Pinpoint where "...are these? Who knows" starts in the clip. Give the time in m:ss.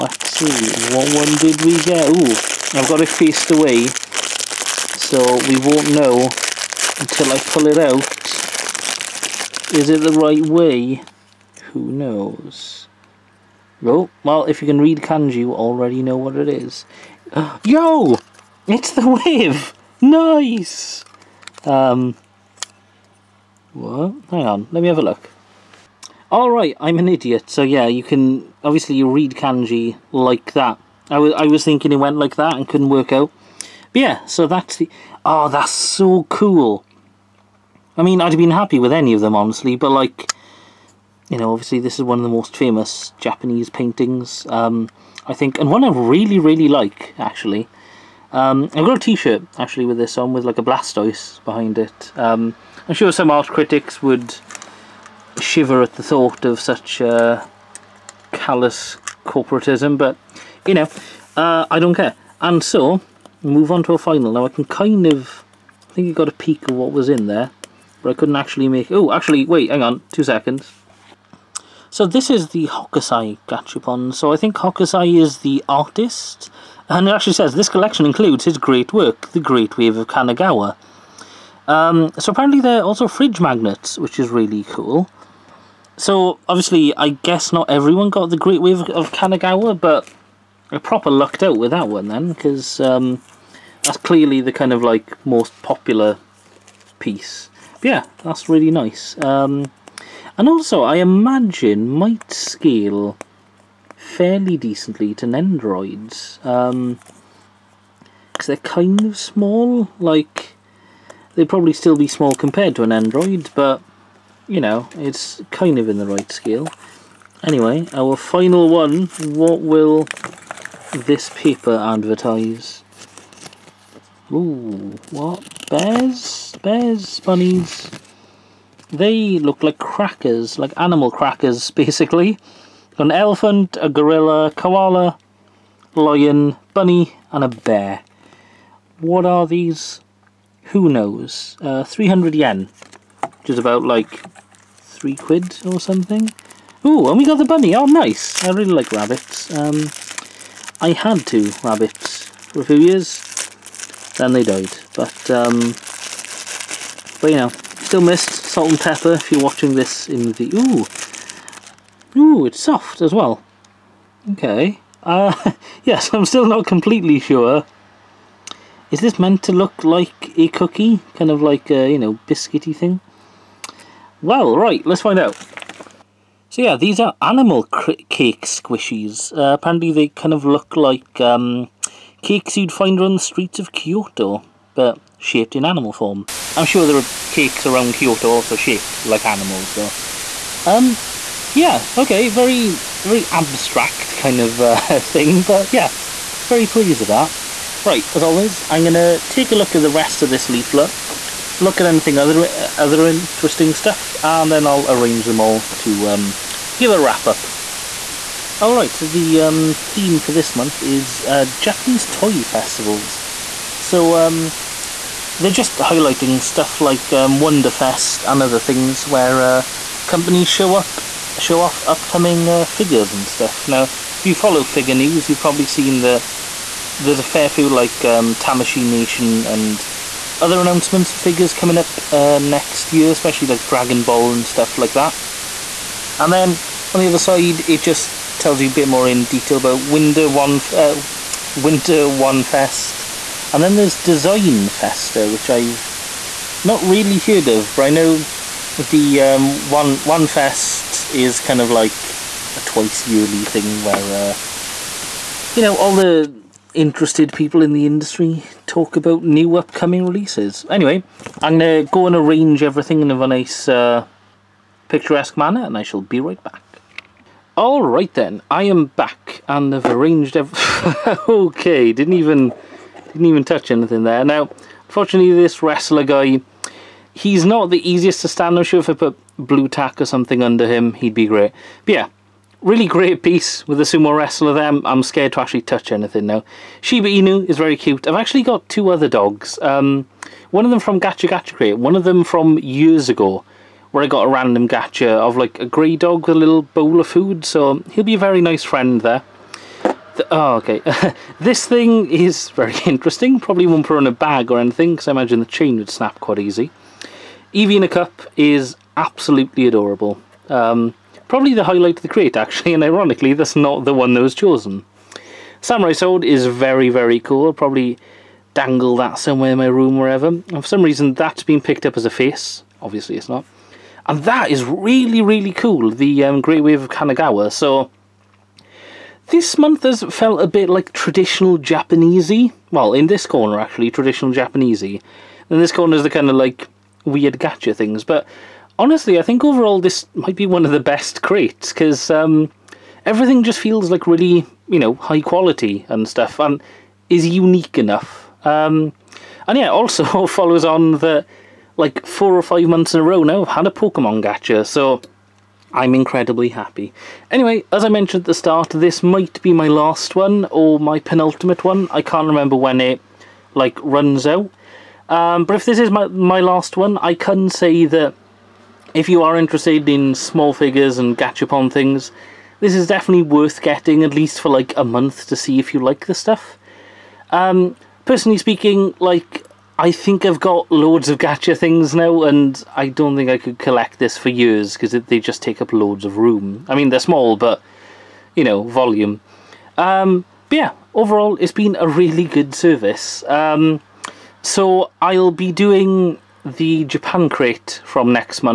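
2:19.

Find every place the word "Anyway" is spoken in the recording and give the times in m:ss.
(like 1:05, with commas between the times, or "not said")
1:57, 4:20, 5:57.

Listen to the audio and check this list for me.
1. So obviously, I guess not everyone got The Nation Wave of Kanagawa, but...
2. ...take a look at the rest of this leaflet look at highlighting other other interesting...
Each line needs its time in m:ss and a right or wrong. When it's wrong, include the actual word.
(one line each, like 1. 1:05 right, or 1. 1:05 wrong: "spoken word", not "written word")
1. 1:25 wrong: "Great", not "Nation"
2. 3:19 wrong: "anything", not "highlighting".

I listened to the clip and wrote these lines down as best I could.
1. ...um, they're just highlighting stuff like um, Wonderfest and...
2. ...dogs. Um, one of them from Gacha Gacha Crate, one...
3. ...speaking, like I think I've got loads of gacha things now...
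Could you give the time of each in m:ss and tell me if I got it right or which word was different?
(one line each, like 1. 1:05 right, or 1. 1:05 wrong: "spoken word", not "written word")
1. 3:34 right
2. 4:49 right
3. 6:18 right.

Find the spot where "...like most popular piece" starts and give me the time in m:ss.
1:34.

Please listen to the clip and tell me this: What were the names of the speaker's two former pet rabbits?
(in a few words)
Salt and Pepper.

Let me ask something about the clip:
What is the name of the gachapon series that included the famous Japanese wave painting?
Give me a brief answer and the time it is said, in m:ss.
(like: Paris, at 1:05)
Hokusai Gachapon, at 1:12.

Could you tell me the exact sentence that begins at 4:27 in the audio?
Alright then, I am back and I've arranged everything.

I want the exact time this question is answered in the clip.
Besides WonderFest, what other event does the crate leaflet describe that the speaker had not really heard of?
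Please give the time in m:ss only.
4:03.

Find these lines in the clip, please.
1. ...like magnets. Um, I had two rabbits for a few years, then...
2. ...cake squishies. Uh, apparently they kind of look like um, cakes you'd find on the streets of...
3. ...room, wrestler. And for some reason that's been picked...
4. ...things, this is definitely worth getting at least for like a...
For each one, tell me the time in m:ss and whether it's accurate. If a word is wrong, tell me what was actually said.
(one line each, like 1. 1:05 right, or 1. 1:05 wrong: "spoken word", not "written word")
1. 2:28 wrong: "rabbits", not "magnets"
2. 2:58 right
3. 5:19 wrong: "wherever", not "wrestler"
4. 6:11 right.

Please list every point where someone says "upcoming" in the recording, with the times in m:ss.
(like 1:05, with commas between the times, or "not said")
3:41, 4:19.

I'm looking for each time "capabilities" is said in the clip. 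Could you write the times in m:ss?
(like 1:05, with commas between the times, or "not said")
not said.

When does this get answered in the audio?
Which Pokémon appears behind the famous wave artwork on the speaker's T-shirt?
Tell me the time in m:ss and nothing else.
0:50.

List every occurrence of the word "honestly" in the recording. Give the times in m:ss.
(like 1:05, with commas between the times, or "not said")
0:39, 5:38.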